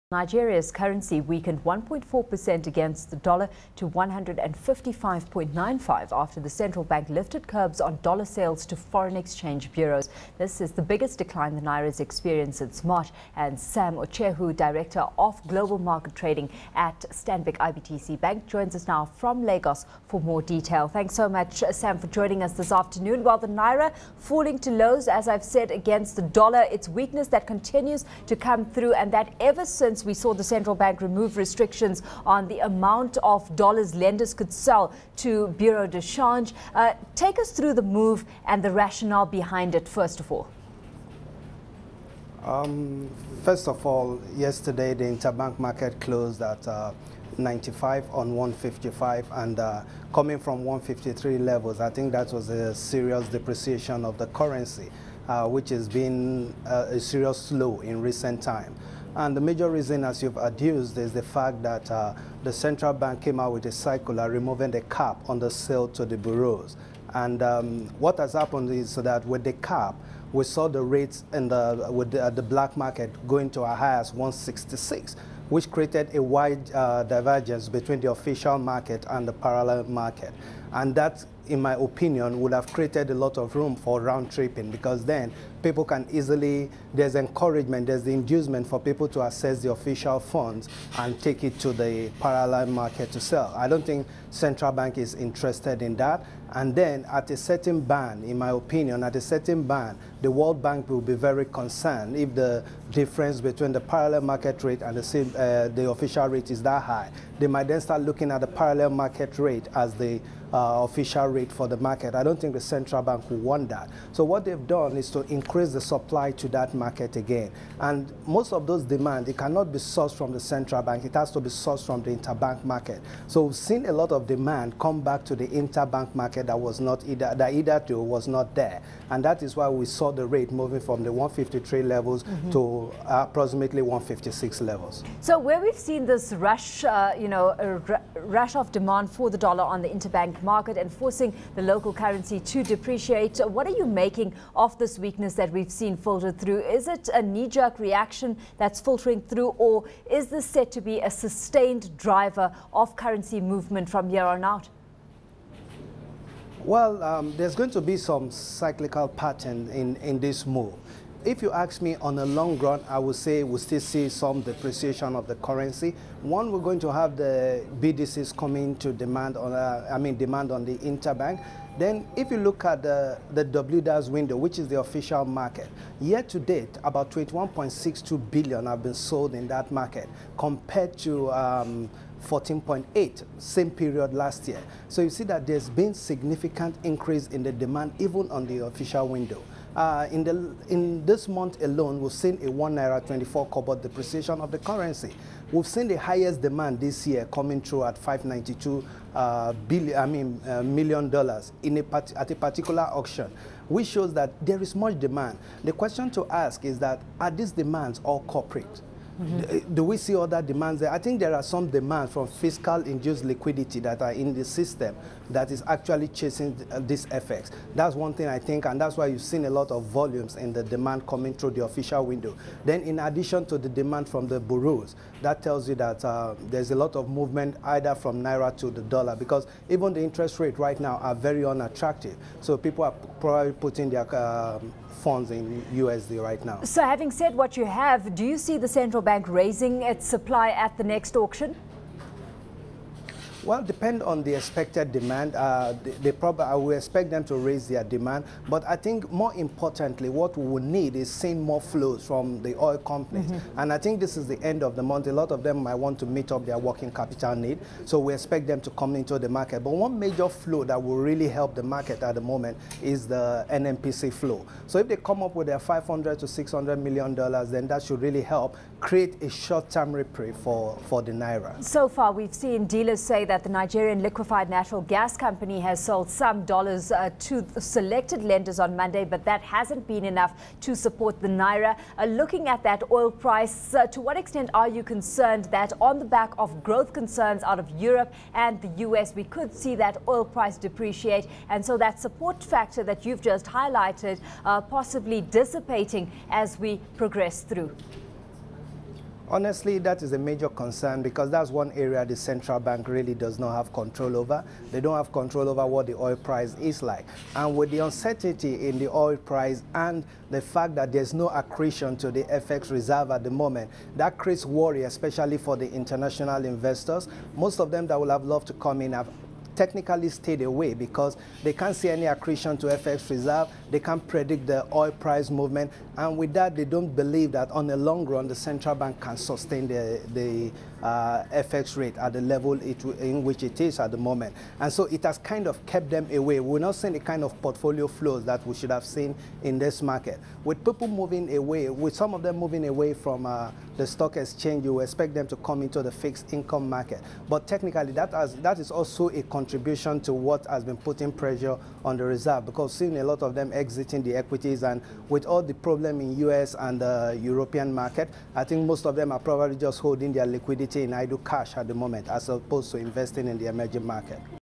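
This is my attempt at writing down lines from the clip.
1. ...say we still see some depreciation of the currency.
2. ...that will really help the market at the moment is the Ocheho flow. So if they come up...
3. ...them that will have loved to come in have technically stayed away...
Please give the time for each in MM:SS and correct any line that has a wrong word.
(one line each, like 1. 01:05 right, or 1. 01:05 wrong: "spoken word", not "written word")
1. 02:43 right
2. 04:20 wrong: "NNPC", not "Ocheho"
3. 05:17 right.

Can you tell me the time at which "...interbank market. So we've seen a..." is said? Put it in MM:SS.
02:02.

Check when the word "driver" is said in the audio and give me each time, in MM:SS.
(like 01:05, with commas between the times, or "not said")
02:31.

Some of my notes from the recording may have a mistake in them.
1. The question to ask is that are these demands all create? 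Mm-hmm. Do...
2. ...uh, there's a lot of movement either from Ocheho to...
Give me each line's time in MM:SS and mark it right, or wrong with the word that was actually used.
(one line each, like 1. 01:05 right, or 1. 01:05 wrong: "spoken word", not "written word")
1. 03:25 wrong: "corporate", not "create"
2. 03:46 wrong: "Naira", not "Ocheho".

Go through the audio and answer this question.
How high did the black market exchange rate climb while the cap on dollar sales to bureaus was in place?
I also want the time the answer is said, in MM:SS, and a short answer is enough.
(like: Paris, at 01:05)
166, at 01:14.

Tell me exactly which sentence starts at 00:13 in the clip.
And Sam Ocheho, director of global market trading at Stanbic IBTC Bank, joins us now from Lagos for more detail.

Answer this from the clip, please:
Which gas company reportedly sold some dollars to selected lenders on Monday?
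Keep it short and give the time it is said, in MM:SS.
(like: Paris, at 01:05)
Nigerian Liquefied Natural Gas Company, at 04:33.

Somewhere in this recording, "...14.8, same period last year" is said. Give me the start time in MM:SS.
03:02.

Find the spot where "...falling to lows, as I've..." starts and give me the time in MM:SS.
00:24.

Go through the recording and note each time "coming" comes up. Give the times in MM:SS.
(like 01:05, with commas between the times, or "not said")
00:50, 02:48, 03:17, 03:41.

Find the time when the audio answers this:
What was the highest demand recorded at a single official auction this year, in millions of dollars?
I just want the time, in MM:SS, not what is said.
03:17.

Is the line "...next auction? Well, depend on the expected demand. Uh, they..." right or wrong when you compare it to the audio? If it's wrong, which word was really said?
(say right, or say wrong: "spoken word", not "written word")
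right.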